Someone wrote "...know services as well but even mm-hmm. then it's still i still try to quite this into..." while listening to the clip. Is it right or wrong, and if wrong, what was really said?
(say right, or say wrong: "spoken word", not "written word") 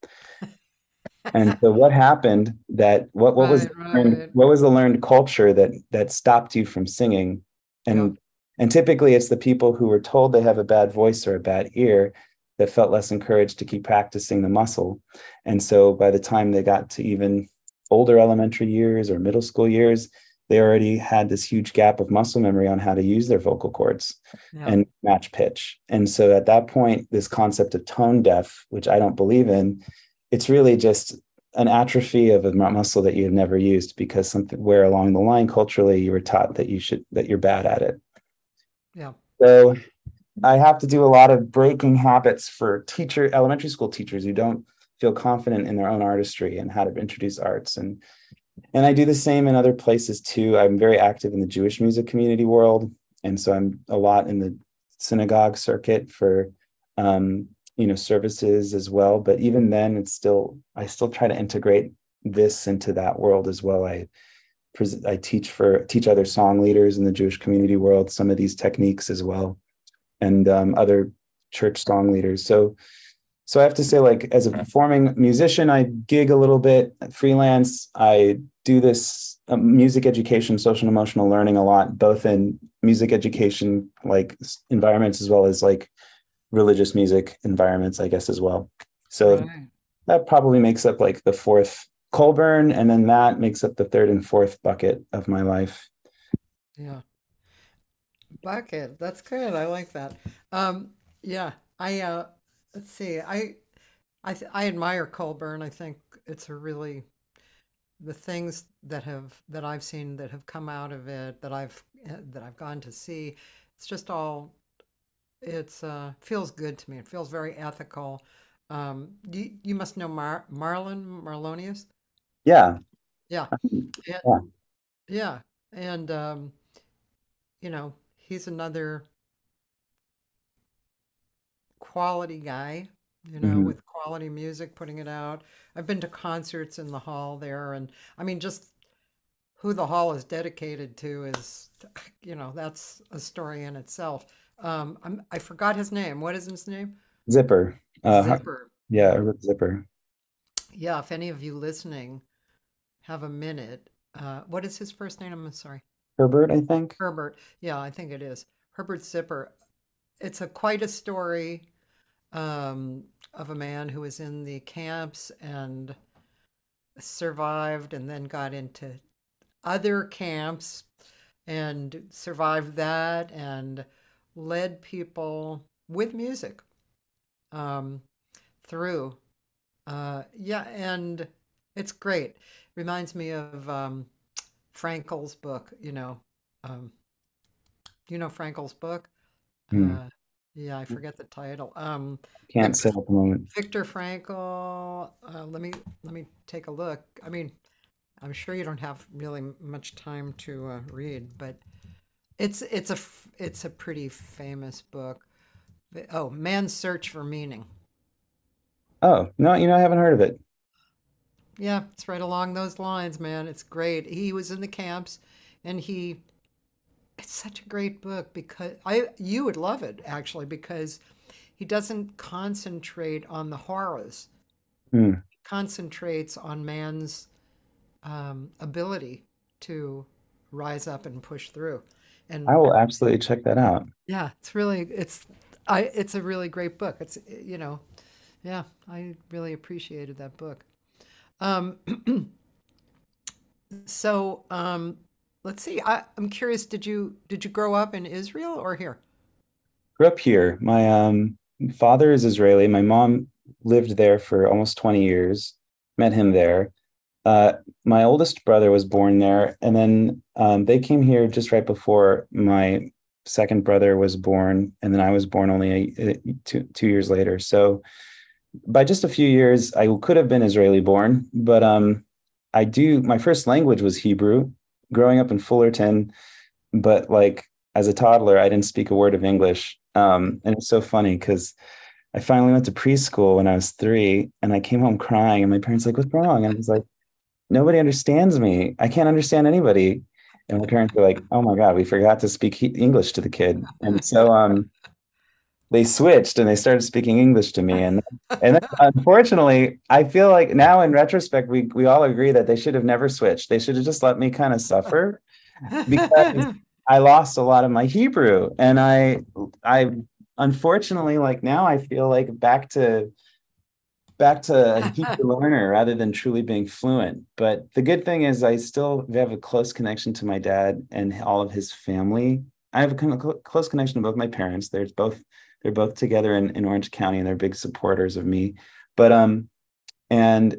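wrong: "integrate", not "quite".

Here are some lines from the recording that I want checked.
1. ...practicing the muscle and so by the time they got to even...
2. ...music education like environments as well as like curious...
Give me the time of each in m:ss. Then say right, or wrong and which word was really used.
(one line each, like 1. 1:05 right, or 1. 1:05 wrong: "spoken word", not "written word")
1. 0:13 right
2. 1:22 wrong: "religious", not "curious".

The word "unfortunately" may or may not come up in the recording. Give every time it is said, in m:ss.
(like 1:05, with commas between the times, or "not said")
4:58, 5:10.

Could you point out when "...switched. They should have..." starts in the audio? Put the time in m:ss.
5:03.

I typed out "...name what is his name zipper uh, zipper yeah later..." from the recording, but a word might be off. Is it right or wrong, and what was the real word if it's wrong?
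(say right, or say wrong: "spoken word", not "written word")
wrong: "zipper", not "later".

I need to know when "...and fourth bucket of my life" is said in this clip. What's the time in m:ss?
1:34.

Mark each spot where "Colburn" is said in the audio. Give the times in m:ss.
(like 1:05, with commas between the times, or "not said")
1:32, 1:45.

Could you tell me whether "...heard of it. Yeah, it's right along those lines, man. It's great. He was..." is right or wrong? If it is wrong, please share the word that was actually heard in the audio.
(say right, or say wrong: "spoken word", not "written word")
right.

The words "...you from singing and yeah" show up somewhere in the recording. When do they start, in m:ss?
0:06.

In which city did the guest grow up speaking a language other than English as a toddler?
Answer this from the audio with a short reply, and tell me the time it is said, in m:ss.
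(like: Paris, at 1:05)
Fullerton, at 4:35.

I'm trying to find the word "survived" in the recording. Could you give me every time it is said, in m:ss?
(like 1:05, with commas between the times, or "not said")
2:46, 2:52.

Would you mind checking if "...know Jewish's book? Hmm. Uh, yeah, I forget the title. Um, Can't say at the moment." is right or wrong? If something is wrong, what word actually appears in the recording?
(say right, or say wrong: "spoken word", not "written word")
wrong: "Frankl", not "Jewish".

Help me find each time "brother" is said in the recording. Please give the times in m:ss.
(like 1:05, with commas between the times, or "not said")
4:18, 4:23.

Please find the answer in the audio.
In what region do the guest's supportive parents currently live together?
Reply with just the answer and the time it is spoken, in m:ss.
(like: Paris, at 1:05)
Orange County, at 5:26.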